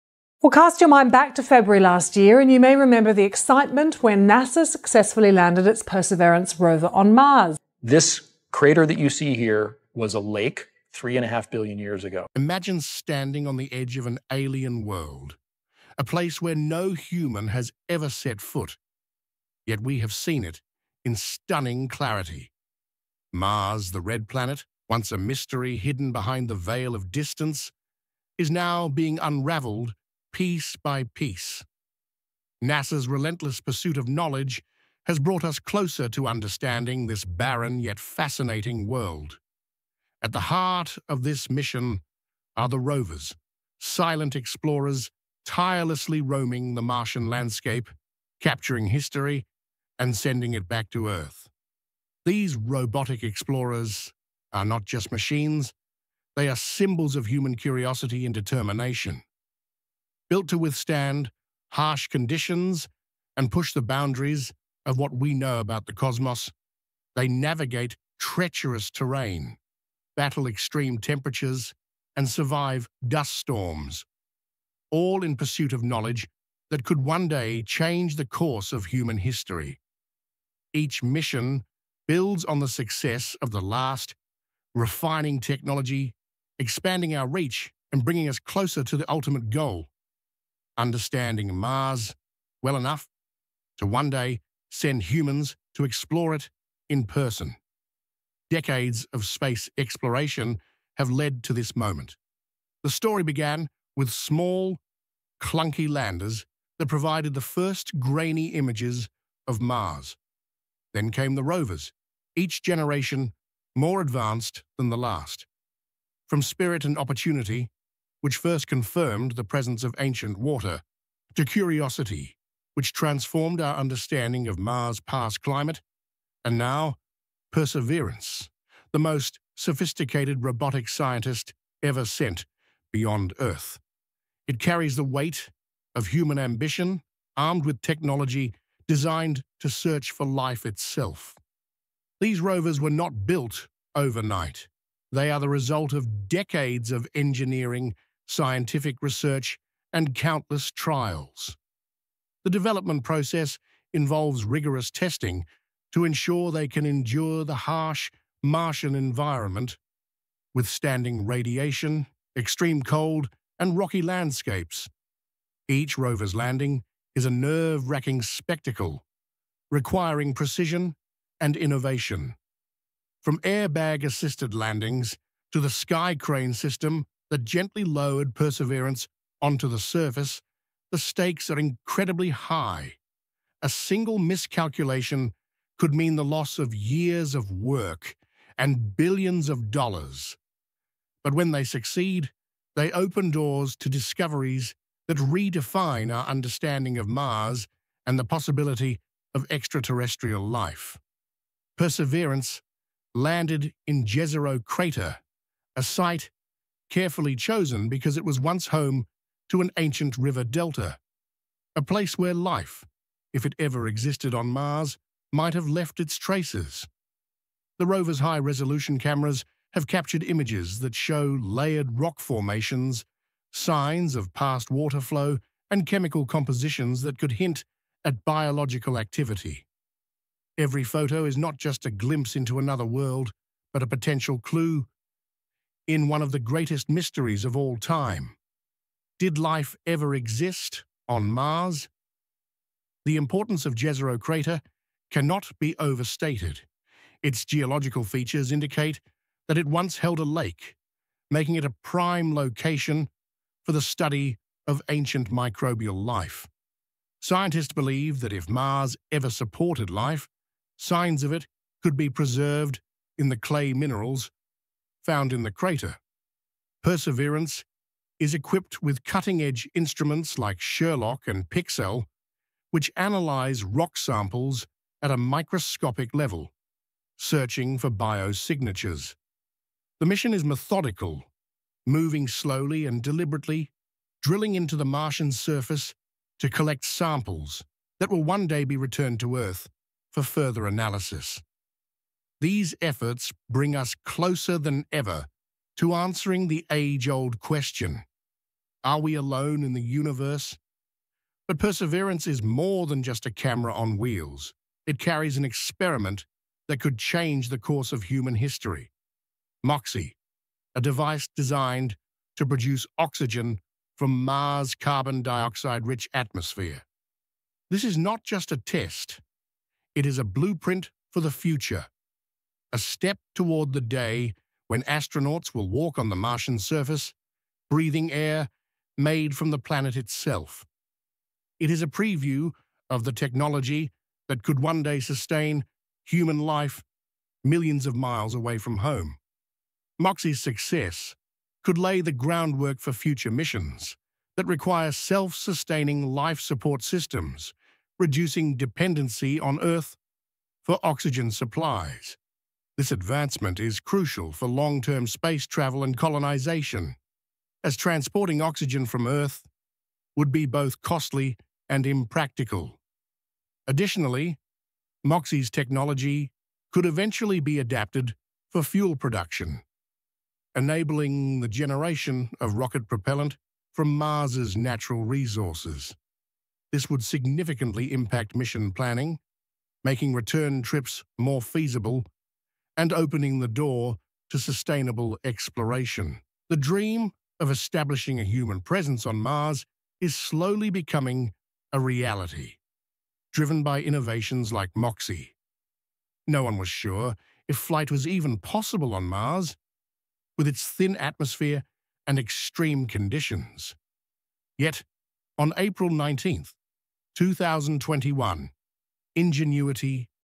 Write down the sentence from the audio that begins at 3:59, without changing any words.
Did life ever exist on Mars?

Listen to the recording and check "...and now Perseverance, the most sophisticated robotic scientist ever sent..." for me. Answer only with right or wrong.
right.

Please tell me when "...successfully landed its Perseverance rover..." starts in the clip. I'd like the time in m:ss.
0:04.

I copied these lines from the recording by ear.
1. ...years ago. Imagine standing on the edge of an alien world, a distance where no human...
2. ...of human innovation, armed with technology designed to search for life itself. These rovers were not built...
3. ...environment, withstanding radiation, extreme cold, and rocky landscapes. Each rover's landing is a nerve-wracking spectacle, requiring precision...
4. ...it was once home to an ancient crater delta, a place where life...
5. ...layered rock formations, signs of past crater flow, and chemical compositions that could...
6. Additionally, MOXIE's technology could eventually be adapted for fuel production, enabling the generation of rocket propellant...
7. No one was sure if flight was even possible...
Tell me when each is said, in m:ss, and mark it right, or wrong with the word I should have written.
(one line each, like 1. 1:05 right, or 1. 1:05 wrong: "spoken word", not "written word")
1. 0:11 wrong: "place", not "distance"
2. 2:15 wrong: "ambition", not "innovation"
3. 2:38 right
4. 3:28 wrong: "river", not "crater"
5. 3:41 wrong: "water", not "crater"
6. 6:03 right
7. 6:36 right.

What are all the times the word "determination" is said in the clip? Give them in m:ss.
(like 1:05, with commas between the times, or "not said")
0:58.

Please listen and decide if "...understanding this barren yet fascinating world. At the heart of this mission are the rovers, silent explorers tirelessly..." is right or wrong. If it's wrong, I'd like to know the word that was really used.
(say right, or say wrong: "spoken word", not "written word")
right.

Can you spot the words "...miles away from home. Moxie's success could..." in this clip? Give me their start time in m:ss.
5:37.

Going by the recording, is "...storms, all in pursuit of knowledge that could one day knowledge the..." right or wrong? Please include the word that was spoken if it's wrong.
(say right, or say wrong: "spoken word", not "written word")
wrong: "change", not "knowledge".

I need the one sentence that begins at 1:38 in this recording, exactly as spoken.
Decades of space exploration have led to this moment.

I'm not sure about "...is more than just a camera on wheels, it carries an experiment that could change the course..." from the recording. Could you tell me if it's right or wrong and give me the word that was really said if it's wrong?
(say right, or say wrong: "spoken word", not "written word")
right.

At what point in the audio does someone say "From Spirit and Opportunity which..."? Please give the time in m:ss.
1:56.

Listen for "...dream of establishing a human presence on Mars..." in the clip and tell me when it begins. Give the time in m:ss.
6:26.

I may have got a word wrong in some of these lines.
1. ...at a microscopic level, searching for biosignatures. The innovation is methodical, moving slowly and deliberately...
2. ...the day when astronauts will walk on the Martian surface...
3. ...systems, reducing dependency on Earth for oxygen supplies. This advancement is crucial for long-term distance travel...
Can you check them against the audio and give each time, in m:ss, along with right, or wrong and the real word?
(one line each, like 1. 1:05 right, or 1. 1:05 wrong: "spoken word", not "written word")
1. 4:35 wrong: "mission", not "innovation"
2. 5:23 right
3. 5:46 wrong: "space", not "distance".